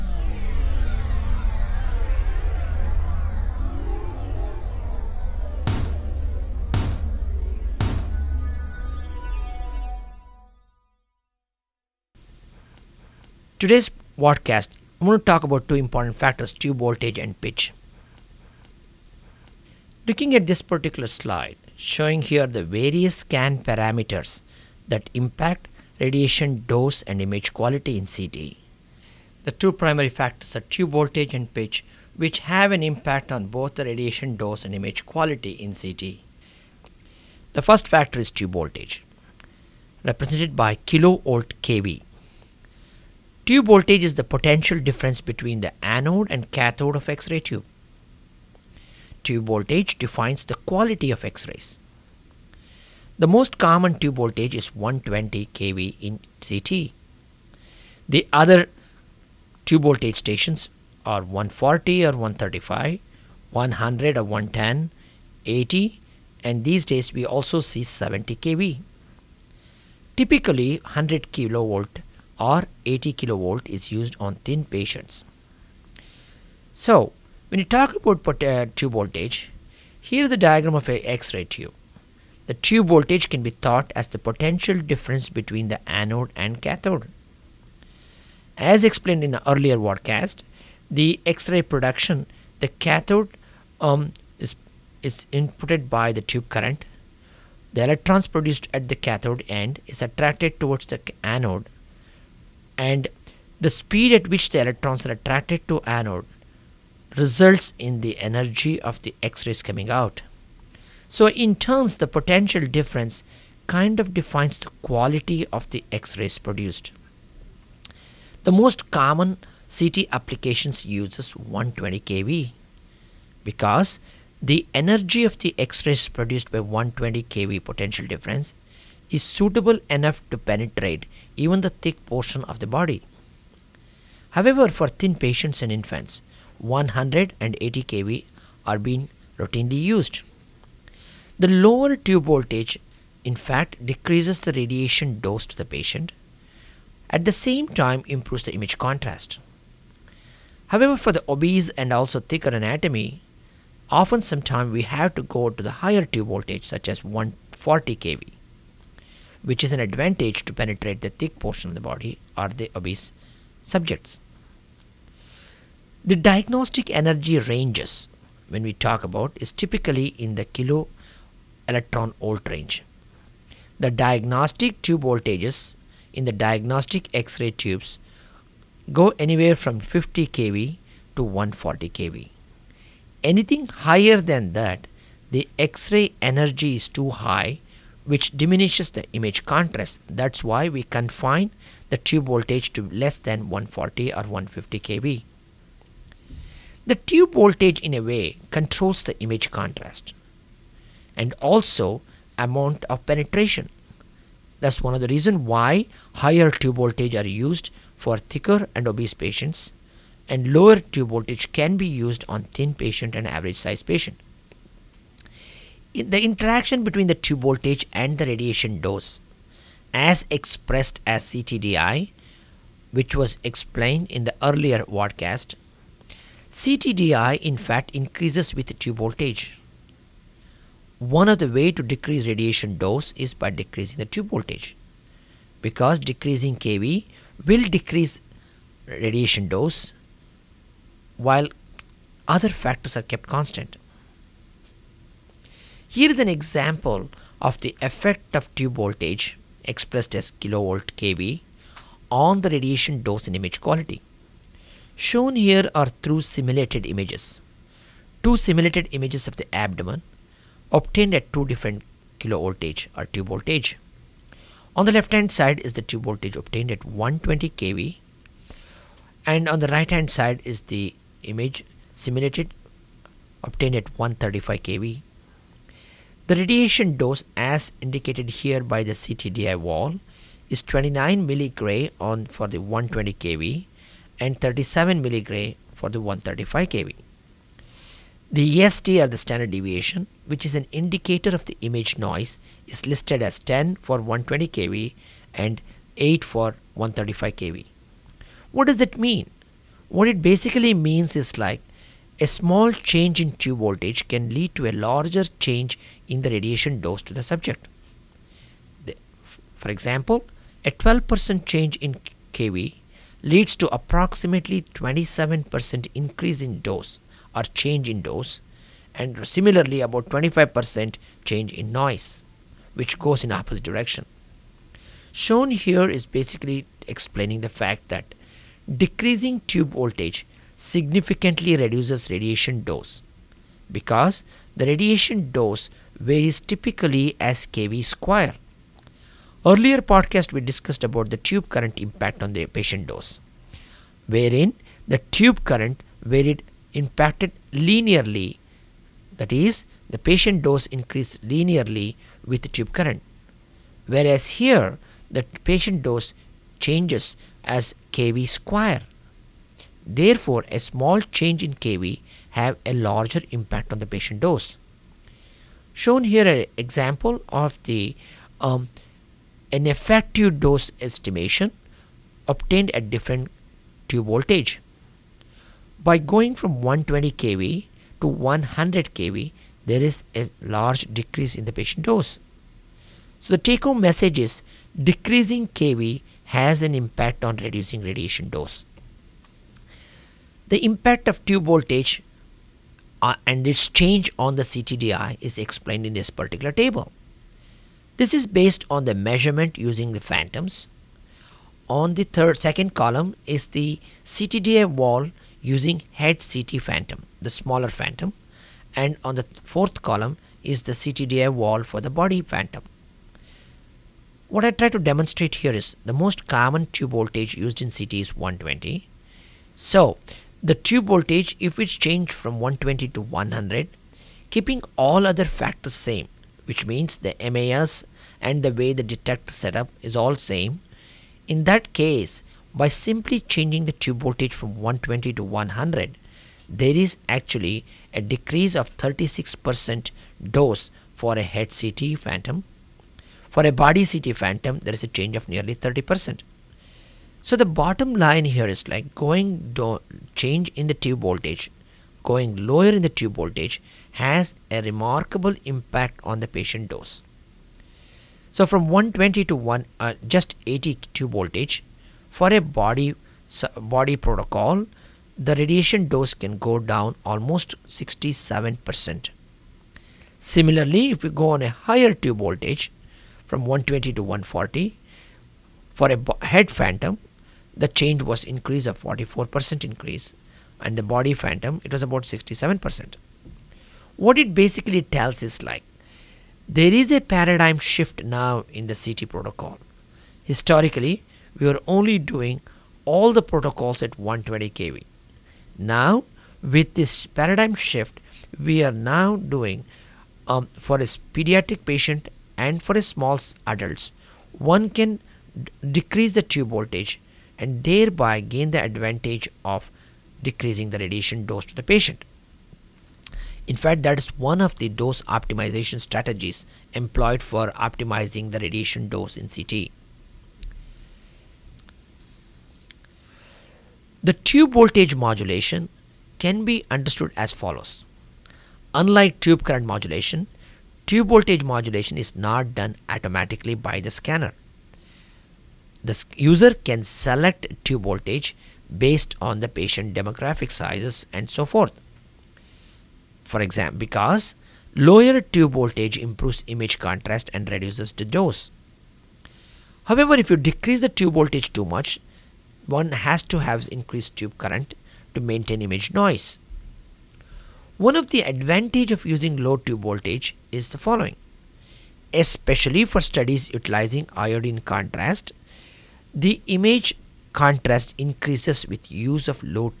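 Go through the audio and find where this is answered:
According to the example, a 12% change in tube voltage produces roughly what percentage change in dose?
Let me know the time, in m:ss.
5:14.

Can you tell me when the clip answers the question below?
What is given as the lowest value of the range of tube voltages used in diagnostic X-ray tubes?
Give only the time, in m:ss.
2:59.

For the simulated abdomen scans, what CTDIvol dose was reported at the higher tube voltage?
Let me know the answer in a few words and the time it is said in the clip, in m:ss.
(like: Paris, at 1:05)
37 milligray, at 4:44.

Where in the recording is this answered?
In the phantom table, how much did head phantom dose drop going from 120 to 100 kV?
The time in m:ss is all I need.
7:18.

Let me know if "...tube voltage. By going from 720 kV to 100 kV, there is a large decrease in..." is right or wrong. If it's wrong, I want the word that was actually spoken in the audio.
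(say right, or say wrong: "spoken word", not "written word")
wrong: "120", not "720".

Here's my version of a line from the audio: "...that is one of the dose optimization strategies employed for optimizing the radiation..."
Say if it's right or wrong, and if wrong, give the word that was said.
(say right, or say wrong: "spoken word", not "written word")
right.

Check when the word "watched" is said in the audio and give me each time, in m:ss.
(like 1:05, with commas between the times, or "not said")
not said.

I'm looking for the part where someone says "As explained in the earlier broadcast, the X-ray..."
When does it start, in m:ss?
1:28.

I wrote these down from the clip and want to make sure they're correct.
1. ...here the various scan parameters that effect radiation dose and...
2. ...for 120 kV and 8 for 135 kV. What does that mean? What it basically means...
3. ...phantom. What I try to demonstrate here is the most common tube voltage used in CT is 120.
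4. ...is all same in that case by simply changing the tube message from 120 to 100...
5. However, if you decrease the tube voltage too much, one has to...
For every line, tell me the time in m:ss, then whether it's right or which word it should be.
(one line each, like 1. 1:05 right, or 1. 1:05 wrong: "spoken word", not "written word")
1. 0:22 wrong: "impact", not "effect"
2. 4:53 right
3. 6:52 right
4. 7:09 wrong: "voltage", not "message"
5. 9:09 right.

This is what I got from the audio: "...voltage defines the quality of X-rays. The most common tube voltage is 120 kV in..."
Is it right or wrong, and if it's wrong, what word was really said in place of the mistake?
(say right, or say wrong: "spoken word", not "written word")
right.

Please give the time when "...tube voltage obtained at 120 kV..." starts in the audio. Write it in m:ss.
4:25.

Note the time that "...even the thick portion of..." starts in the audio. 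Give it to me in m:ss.
2:11.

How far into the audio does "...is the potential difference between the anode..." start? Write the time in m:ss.
0:44.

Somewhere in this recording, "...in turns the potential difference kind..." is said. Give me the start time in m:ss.
1:51.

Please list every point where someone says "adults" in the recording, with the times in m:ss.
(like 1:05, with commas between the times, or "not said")
8:23.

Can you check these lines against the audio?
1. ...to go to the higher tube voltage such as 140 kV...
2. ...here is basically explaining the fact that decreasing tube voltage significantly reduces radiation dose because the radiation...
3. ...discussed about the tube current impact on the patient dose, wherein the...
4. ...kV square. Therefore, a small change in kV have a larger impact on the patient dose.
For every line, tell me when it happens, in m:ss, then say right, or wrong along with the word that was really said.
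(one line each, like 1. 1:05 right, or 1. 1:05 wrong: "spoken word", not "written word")
1. 2:35 right
2. 5:25 right
3. 5:40 right
4. 5:57 right.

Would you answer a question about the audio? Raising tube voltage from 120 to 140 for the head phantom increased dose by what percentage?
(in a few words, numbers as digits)
44%.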